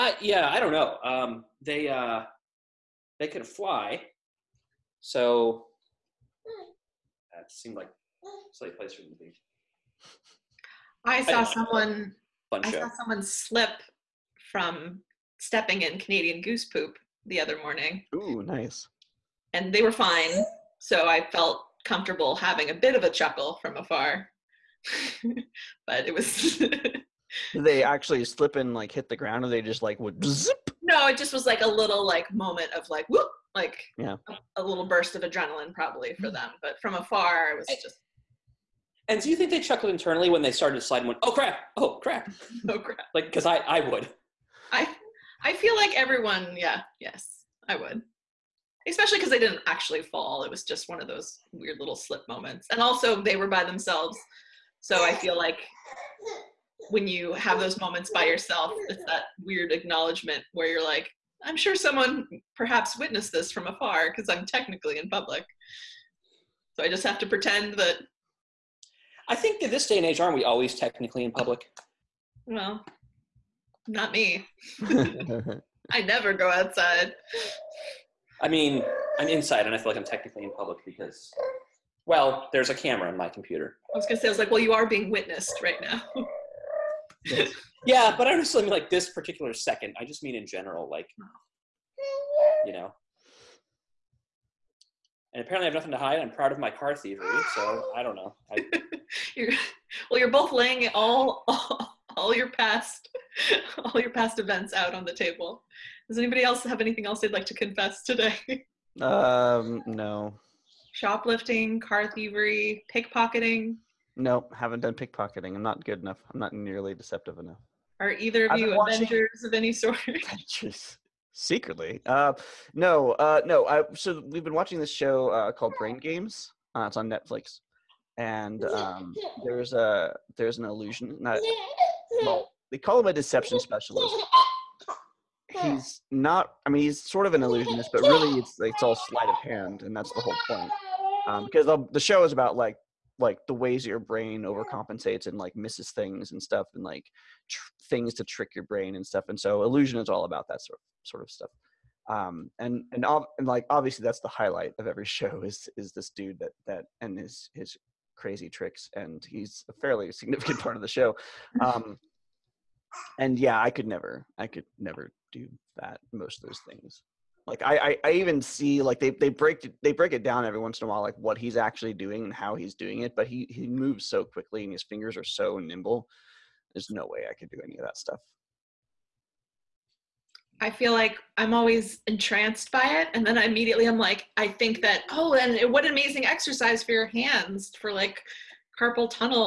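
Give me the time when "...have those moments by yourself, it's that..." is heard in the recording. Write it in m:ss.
0:57.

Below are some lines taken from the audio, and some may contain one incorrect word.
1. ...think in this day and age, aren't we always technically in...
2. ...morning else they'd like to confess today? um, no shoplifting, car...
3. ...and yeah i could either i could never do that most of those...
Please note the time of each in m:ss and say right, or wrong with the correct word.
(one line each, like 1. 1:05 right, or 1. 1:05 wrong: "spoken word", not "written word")
1. 1:09 right
2. 1:46 wrong: "anything", not "morning"
3. 2:43 wrong: "never", not "either".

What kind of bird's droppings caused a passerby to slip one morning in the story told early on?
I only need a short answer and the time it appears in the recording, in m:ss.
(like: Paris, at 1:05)
Canadian goose, at 0:15.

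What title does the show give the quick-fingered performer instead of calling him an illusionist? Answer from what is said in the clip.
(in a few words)
deception specialist.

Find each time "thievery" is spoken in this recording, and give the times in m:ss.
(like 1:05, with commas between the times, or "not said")
1:36, 1:52.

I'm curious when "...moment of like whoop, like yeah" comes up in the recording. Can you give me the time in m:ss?
0:32.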